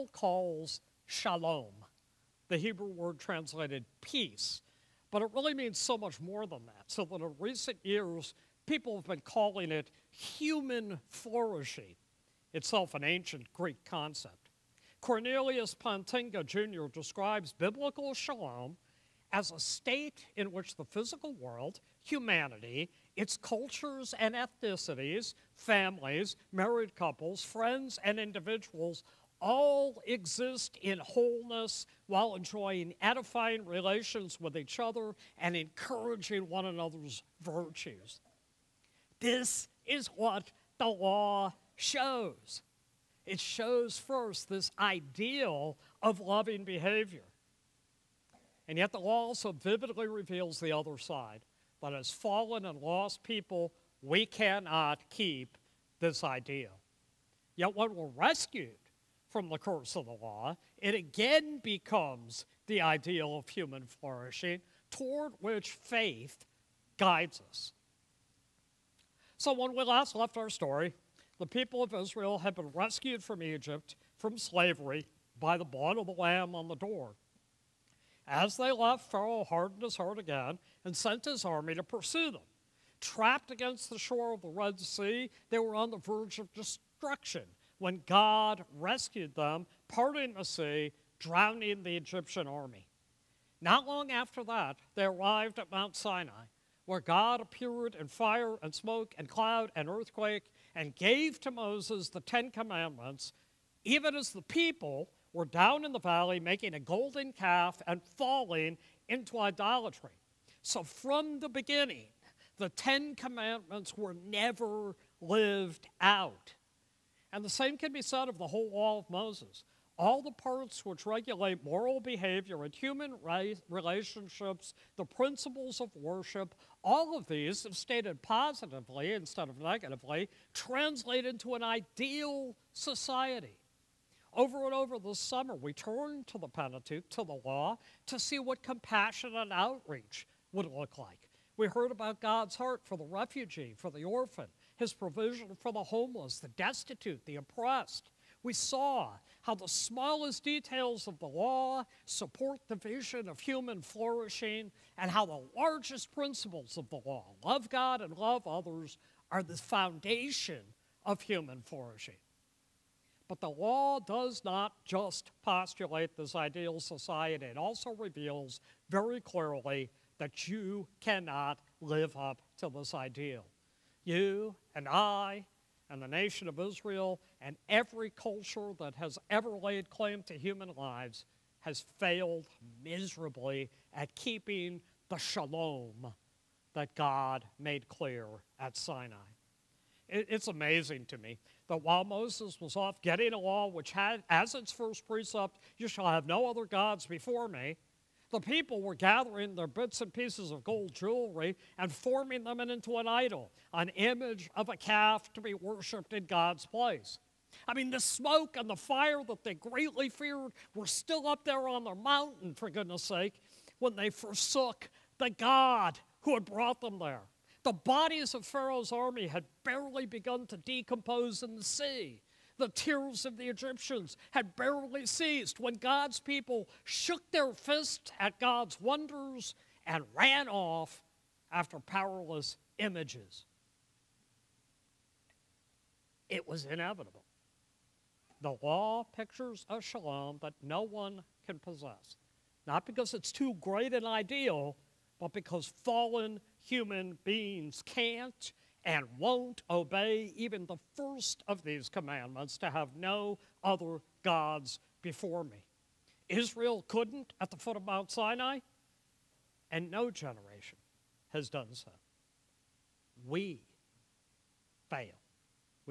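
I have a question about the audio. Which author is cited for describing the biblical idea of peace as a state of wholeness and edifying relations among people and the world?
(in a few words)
Cornelius Plantinga Jr.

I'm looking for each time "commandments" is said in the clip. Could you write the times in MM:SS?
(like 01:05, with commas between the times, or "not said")
01:42, 01:53, 04:11.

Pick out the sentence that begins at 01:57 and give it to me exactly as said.
And the same can be said of the whole law of Moses.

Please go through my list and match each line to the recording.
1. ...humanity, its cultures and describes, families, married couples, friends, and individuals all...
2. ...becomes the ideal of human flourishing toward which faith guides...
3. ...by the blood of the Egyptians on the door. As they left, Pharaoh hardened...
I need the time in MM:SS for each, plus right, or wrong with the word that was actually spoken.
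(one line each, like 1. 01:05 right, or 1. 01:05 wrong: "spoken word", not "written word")
1. 00:22 wrong: "ethnicities", not "describes"
2. 01:01 right
3. 01:15 wrong: "Lamb", not "Egyptians".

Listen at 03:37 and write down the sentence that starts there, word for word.
The bodies of Pharaoh's army had barely begun to decompose in the sea.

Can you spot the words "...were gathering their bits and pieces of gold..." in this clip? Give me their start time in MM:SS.
03:18.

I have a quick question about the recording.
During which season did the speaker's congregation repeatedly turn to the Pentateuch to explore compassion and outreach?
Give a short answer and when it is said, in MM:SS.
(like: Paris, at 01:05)
summer, at 02:15.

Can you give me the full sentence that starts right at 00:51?
But as fallen and lost people, we cannot keep this idea.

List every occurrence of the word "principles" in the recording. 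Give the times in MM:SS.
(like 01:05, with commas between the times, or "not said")
02:05, 02:36.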